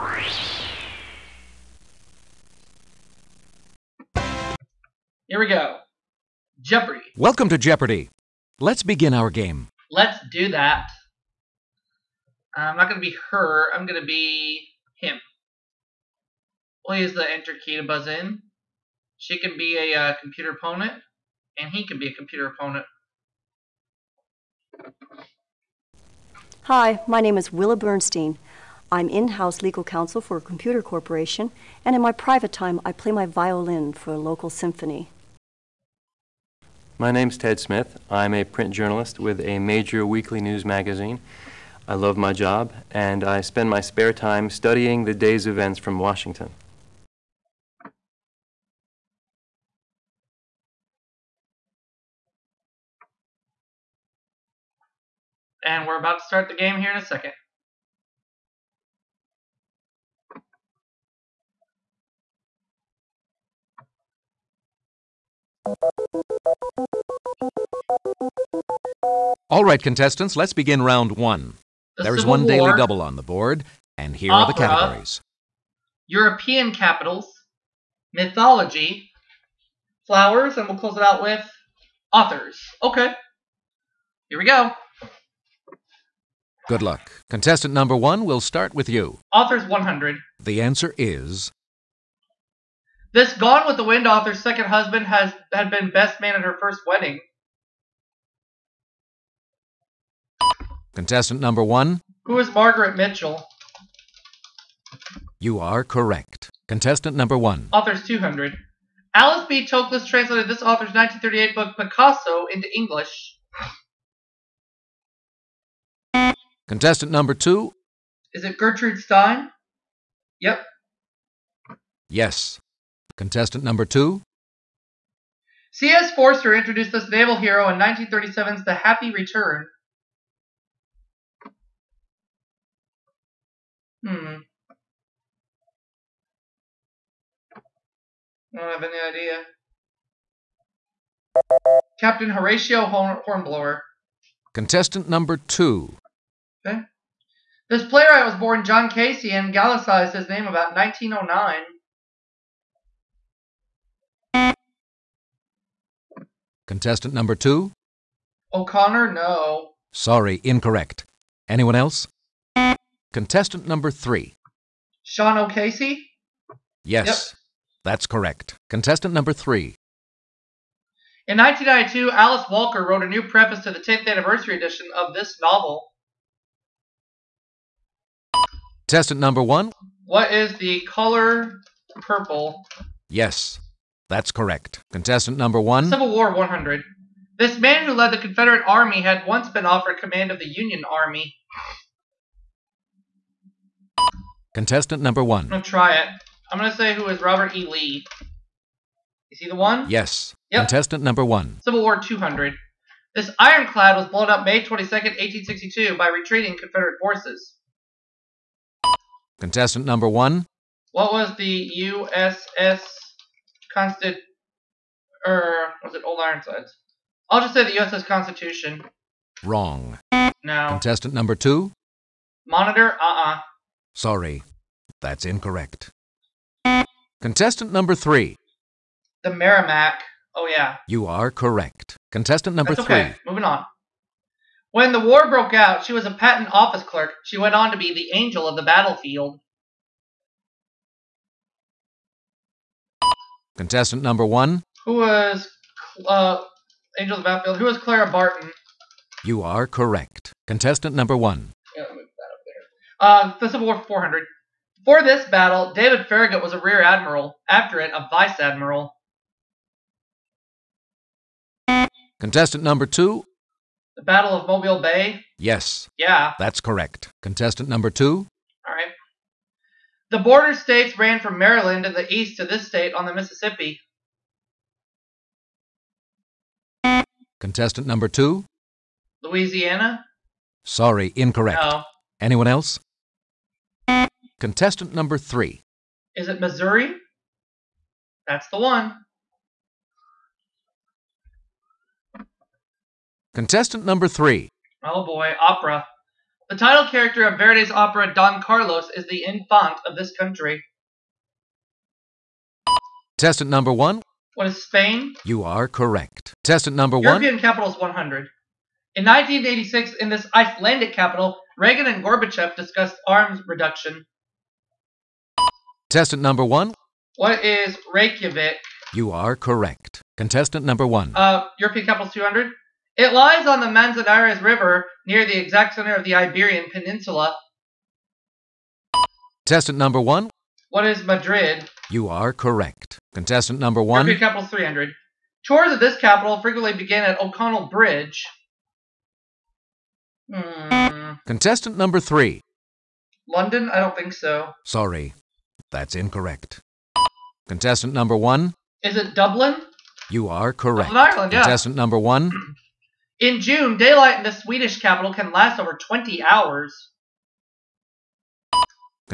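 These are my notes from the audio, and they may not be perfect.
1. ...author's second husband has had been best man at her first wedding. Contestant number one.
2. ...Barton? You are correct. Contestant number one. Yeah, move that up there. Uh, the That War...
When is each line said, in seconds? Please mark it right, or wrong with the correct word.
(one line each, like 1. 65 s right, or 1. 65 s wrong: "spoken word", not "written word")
1. 94 s right
2. 248 s wrong: "Civil", not "That".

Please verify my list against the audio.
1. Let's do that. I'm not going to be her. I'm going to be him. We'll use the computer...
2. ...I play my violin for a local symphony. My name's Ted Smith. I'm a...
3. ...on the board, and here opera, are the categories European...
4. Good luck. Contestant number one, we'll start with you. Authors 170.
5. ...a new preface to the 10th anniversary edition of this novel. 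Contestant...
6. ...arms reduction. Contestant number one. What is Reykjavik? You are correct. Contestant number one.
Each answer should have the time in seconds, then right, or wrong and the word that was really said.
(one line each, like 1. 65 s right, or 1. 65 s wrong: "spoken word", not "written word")
1. 9 s wrong: "enter", not "computer"
2. 32 s right
3. 73 s right
4. 86 s wrong: "100", not "170"
5. 173 s right
6. 313 s right.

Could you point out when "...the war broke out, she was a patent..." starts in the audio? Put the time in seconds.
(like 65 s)
234 s.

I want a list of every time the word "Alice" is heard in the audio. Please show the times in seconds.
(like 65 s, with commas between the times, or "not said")
109 s, 172 s.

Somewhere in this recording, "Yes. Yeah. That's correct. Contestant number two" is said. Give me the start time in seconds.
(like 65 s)
265 s.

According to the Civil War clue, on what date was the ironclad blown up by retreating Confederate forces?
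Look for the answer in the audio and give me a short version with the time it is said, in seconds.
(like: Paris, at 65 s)
May 22, 1862, at 204 s.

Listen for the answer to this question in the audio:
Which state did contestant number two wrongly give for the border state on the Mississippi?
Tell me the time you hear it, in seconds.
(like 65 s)
279 s.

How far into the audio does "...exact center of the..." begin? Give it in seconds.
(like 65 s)
325 s.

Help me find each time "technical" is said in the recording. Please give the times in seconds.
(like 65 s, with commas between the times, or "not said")
not said.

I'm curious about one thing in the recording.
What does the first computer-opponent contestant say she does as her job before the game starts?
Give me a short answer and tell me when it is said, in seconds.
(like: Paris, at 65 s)
In-house legal counsel, at 29 s.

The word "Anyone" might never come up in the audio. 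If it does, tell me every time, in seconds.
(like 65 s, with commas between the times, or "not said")
161 s, 282 s.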